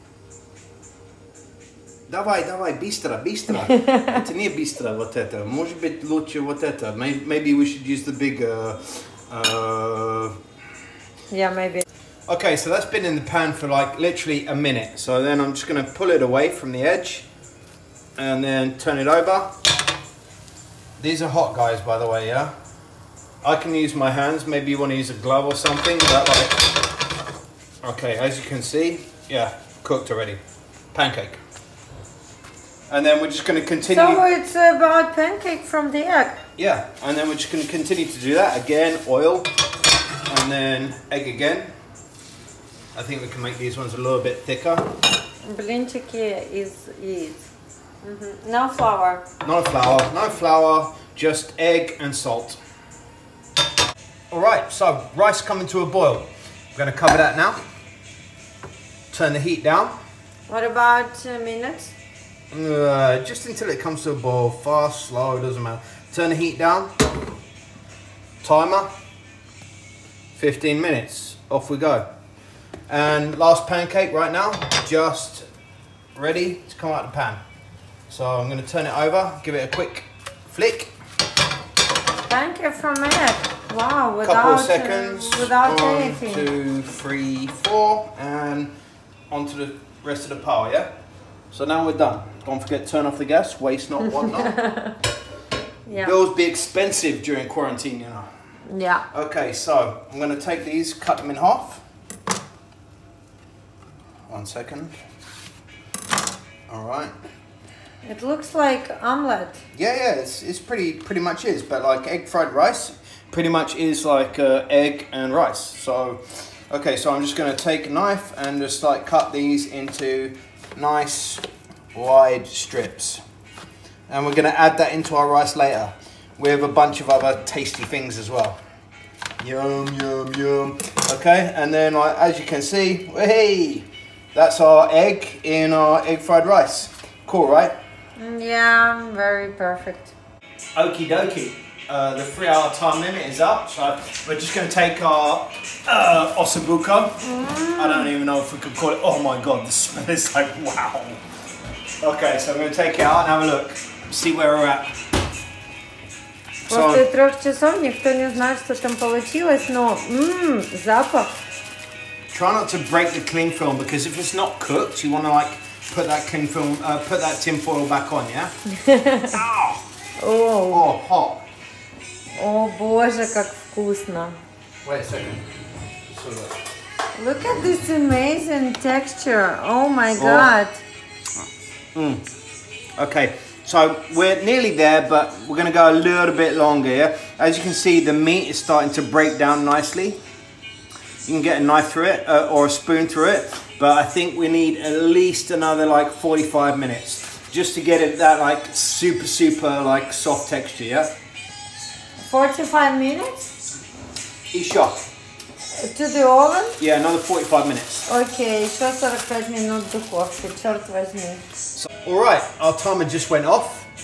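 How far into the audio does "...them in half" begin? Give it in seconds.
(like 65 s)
101 s.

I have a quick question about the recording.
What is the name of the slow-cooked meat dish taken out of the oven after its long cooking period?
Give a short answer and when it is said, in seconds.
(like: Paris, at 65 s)
ossobuco, at 146 s.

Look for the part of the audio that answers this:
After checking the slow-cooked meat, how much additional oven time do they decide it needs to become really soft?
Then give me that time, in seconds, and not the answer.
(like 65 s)
195 s.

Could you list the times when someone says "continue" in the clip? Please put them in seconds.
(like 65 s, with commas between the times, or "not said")
33 s, 37 s.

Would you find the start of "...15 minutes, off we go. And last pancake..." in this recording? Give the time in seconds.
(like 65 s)
70 s.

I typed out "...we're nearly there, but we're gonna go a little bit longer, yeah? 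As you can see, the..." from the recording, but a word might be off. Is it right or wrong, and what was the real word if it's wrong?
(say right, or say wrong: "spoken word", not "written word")
right.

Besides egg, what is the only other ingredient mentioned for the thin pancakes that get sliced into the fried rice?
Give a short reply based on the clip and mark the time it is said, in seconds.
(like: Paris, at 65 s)
salt, at 51 s.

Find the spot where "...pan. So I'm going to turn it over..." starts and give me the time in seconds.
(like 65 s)
77 s.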